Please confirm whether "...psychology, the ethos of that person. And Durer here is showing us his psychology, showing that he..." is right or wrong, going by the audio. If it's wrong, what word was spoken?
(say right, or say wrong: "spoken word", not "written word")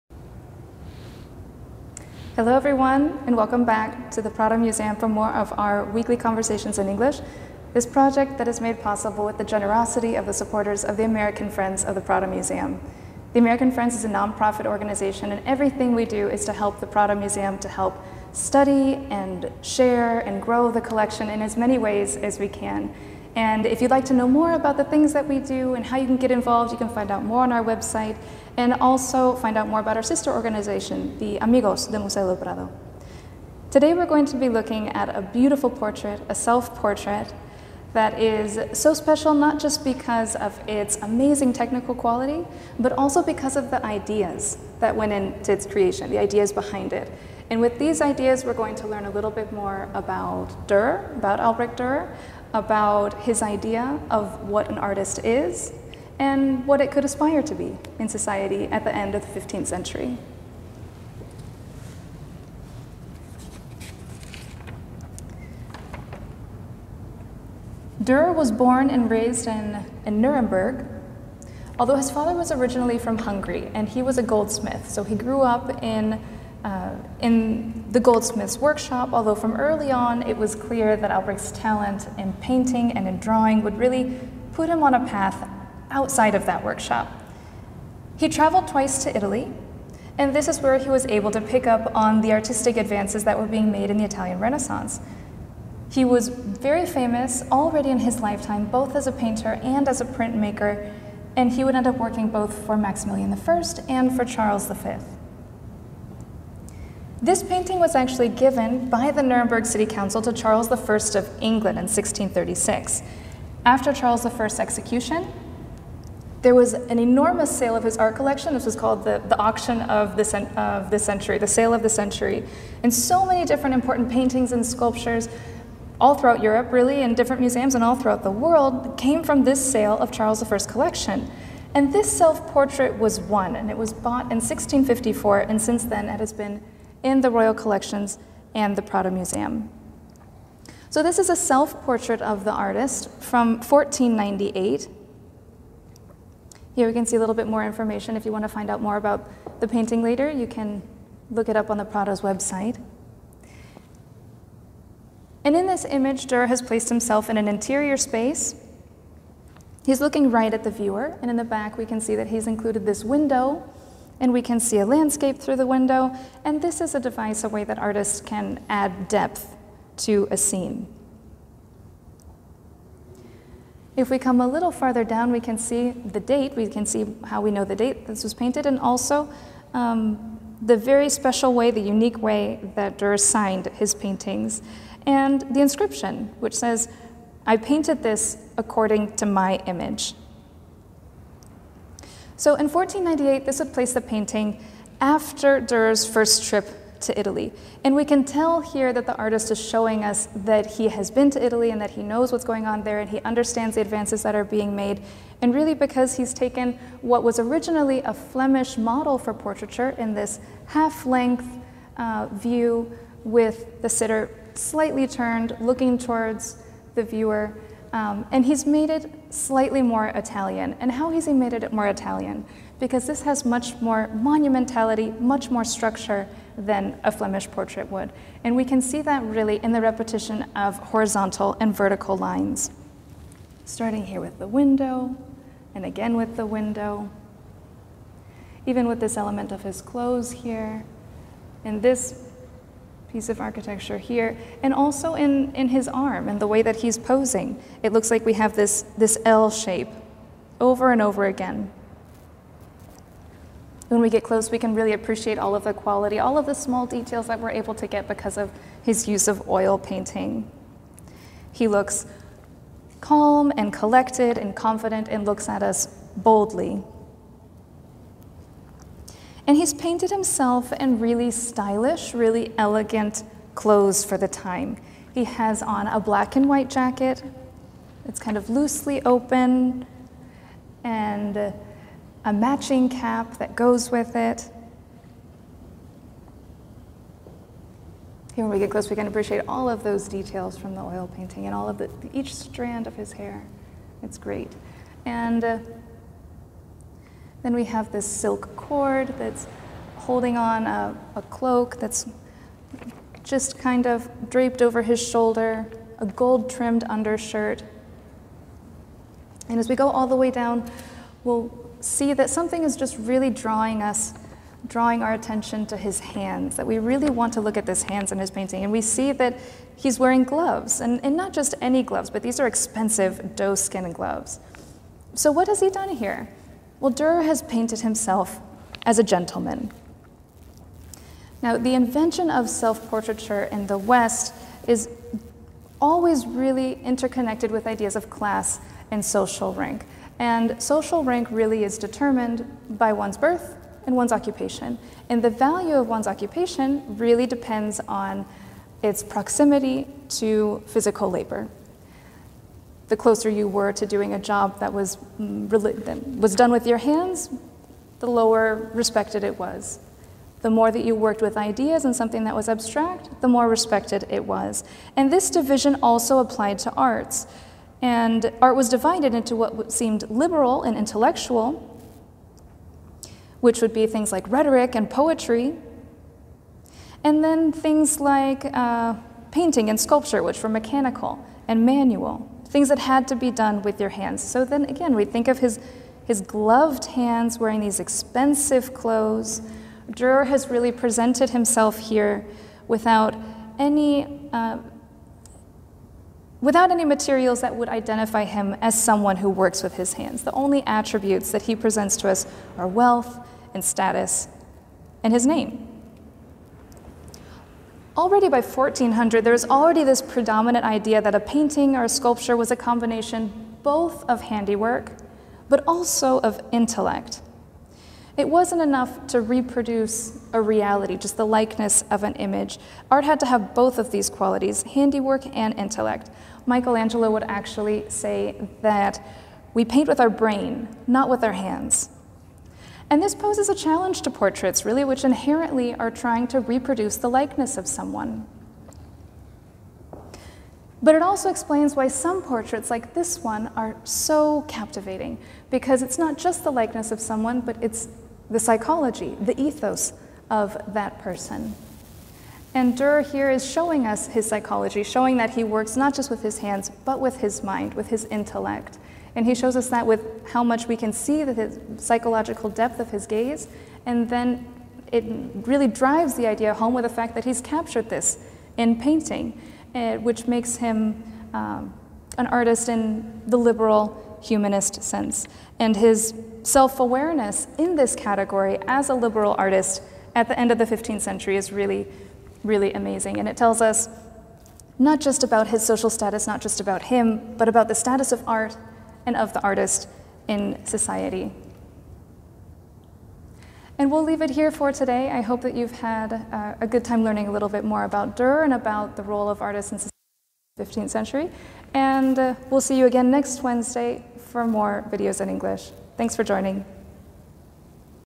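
right.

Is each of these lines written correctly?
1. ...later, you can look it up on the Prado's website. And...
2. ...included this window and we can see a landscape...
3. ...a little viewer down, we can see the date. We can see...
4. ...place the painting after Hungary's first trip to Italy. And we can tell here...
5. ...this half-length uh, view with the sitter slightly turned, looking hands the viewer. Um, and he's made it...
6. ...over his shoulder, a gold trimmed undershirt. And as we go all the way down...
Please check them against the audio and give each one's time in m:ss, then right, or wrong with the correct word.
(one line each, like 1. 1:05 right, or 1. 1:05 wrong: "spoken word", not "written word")
1. 2:30 right
2. 2:42 right
3. 2:54 wrong: "farther", not "viewer"
4. 3:13 wrong: "Durer", not "Hungary"
5. 3:30 wrong: "towards", not "hands"
6. 5:04 right.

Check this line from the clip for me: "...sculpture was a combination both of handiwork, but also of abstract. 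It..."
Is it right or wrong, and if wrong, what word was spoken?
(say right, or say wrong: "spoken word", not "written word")
wrong: "intellect", not "abstract".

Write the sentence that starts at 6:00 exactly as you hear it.
The more that you worked with ideas and something that was abstract, the more respected it was.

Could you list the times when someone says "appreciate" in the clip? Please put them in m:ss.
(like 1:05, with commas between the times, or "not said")
4:14, 4:49.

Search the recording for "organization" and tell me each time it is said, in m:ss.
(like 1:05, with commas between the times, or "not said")
0:14, 0:30.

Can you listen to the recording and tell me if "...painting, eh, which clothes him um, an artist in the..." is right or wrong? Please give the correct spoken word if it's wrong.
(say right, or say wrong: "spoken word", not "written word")
wrong: "makes", not "clothes".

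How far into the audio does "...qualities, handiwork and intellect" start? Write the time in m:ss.
7:04.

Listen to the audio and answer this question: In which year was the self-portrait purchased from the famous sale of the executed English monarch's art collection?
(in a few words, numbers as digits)
1654.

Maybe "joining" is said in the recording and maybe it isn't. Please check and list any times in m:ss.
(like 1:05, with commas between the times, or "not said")
8:26.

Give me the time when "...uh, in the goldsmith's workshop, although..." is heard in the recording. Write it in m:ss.
1:16.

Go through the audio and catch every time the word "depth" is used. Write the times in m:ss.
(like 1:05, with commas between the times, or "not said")
2:49, 7:42.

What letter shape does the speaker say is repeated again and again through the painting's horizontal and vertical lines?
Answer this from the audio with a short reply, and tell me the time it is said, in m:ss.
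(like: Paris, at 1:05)
L shape, at 4:09.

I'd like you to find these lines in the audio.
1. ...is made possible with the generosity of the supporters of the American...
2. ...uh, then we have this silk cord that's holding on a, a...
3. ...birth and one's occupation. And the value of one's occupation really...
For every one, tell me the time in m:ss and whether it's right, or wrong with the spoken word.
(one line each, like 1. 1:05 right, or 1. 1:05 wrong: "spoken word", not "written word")
1. 0:08 right
2. 4:55 right
3. 5:43 right.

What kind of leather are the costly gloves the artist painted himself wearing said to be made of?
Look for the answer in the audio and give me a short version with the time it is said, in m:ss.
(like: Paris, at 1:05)
doe skin, at 5:23.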